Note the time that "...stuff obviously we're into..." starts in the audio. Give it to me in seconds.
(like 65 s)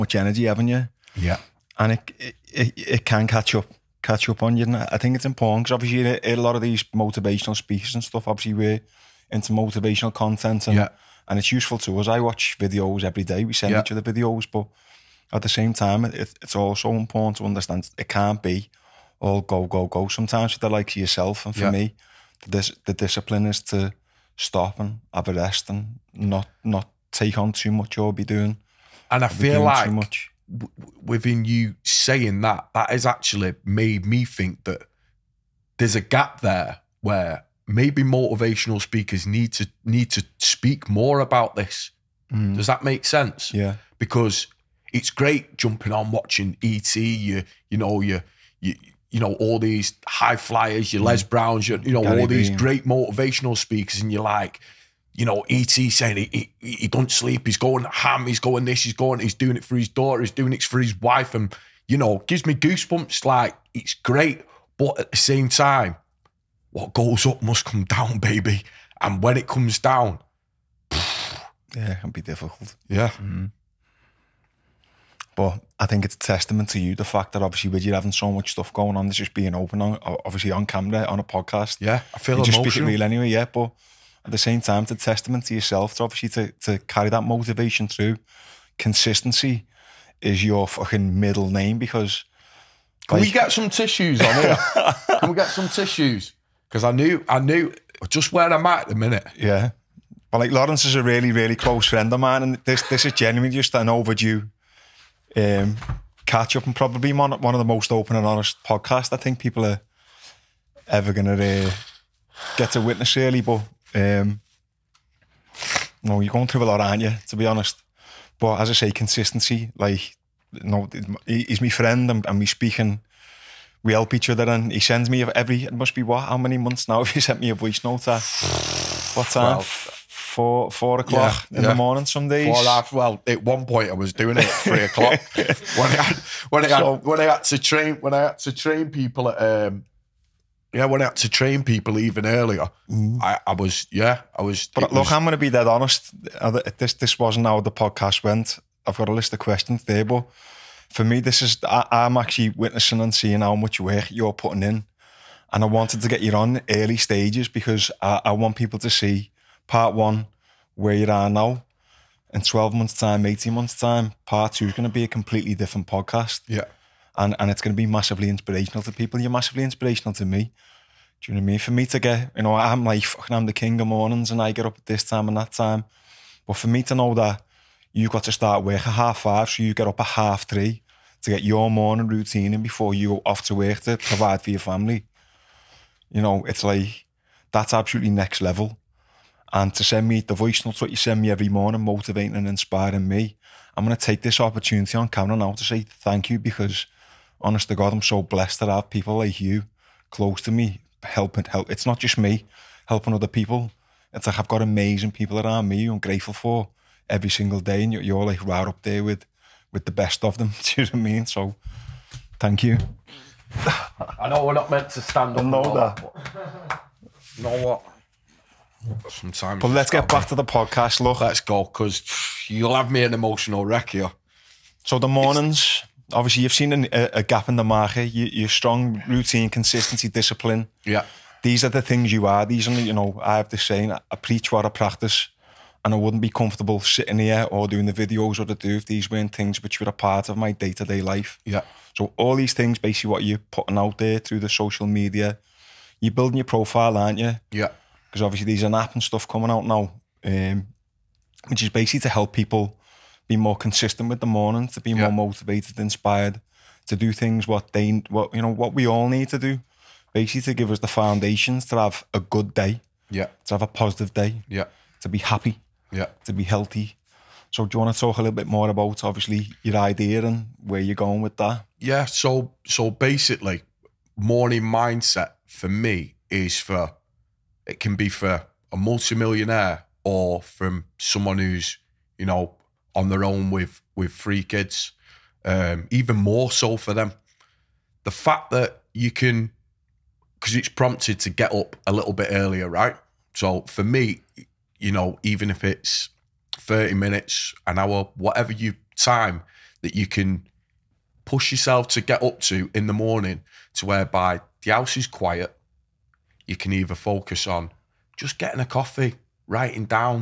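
8 s.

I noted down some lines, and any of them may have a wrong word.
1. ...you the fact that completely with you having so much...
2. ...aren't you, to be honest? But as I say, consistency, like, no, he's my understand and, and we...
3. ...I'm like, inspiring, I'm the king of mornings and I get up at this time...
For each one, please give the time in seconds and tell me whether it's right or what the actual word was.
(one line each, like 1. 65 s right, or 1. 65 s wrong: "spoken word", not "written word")
1. 76 s wrong: "obviously", not "completely"
2. 116 s wrong: "friend", not "understand"
3. 172 s wrong: "fucking", not "inspiring".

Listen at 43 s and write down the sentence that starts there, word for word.
Because it's great jumping on watching ET.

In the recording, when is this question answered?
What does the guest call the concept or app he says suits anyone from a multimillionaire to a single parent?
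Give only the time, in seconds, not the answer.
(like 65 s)
274 s.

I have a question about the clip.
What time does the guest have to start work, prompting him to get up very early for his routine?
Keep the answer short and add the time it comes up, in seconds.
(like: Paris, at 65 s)
half five, at 178 s.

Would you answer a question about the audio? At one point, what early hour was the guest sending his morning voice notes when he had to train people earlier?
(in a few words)
3 o'clock.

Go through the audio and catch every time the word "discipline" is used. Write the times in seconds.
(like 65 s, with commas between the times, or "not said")
22 s, 230 s.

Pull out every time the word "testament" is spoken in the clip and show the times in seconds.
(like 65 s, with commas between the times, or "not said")
76 s, 84 s.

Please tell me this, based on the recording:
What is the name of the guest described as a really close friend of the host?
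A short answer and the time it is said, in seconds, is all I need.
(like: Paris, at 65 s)
Laurence, at 100 s.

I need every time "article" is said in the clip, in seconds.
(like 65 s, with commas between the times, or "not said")
not said.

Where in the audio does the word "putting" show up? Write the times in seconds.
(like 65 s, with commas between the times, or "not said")
154 s, 243 s.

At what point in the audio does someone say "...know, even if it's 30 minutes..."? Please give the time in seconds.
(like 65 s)
294 s.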